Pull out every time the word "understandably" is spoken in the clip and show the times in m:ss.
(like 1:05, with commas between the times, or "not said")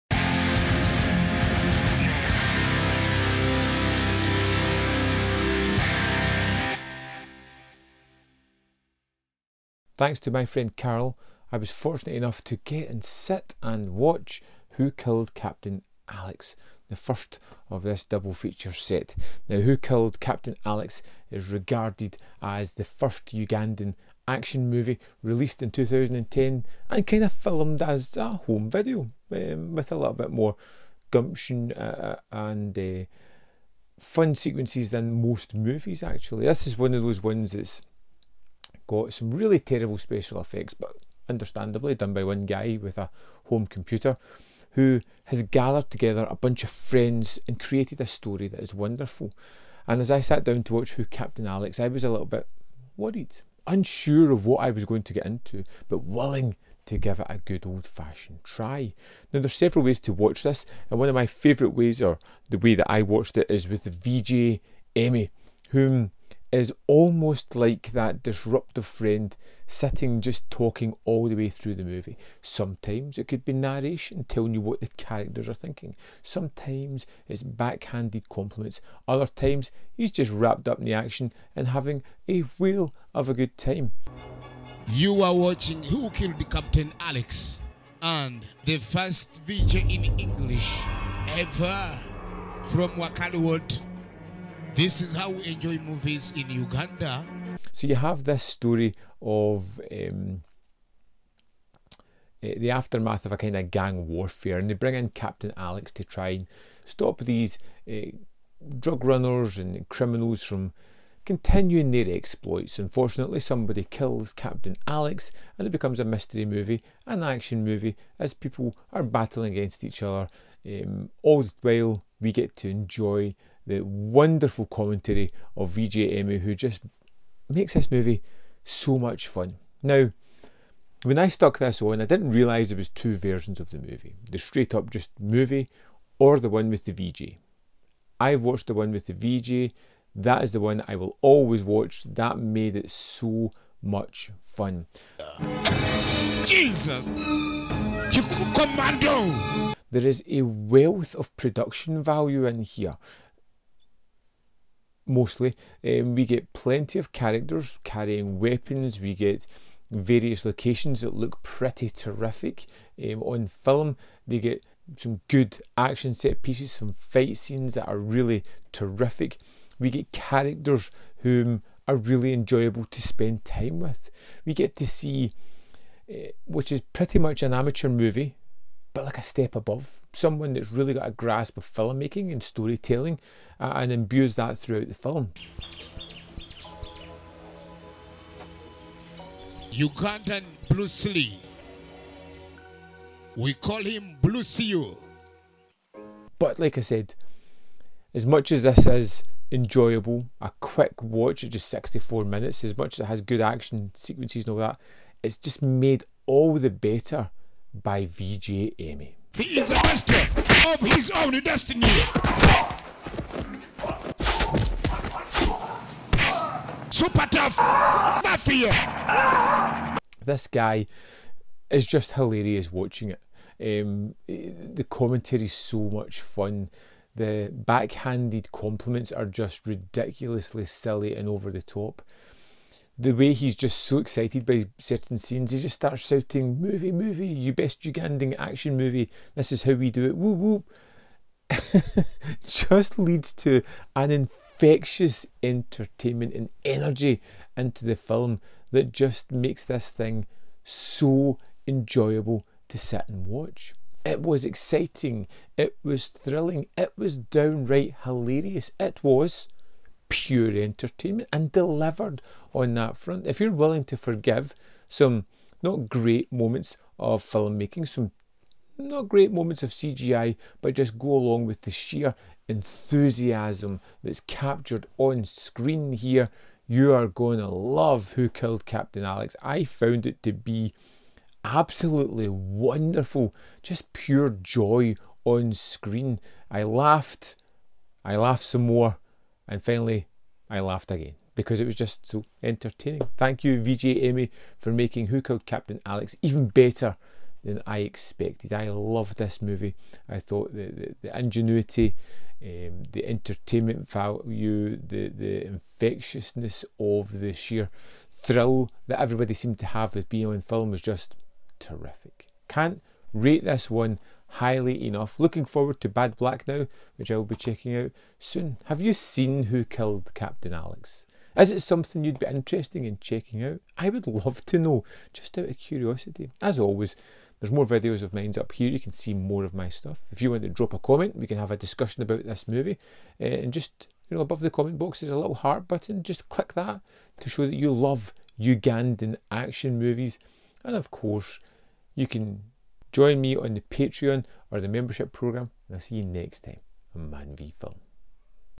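0:41.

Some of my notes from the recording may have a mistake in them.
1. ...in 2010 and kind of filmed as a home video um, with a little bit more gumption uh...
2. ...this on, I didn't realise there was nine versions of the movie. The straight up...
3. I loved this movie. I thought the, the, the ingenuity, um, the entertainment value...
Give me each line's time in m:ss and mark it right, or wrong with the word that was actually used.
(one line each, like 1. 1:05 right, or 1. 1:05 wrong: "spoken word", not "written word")
1. 0:25 right
2. 2:11 wrong: "two", not "nine"
3. 4:58 right.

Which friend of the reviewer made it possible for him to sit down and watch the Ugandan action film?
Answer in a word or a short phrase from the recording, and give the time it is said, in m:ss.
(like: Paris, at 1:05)
Carol, at 0:10.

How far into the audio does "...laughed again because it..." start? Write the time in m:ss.
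4:50.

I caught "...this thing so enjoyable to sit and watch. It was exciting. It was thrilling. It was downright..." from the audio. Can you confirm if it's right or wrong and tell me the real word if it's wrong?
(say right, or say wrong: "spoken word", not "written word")
right.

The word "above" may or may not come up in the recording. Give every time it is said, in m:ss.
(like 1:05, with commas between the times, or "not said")
2:59, 5:34.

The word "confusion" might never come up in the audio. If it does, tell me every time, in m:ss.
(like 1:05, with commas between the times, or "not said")
not said.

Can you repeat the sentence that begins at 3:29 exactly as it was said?
He is a master of his own destiny.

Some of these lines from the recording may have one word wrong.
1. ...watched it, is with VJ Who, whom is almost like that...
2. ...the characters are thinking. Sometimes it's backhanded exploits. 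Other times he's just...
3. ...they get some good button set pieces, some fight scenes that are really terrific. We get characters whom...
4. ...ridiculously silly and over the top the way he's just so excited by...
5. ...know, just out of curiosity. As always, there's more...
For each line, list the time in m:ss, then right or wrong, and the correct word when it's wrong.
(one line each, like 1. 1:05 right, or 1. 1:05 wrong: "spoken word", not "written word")
1. 1:03 wrong: "Emmie", not "Who"
2. 1:14 wrong: "compliments", not "exploits"
3. 2:44 wrong: "action", not "button"
4. 3:49 right
5. 5:24 right.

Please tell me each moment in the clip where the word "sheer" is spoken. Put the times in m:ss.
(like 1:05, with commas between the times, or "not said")
4:31, 5:07.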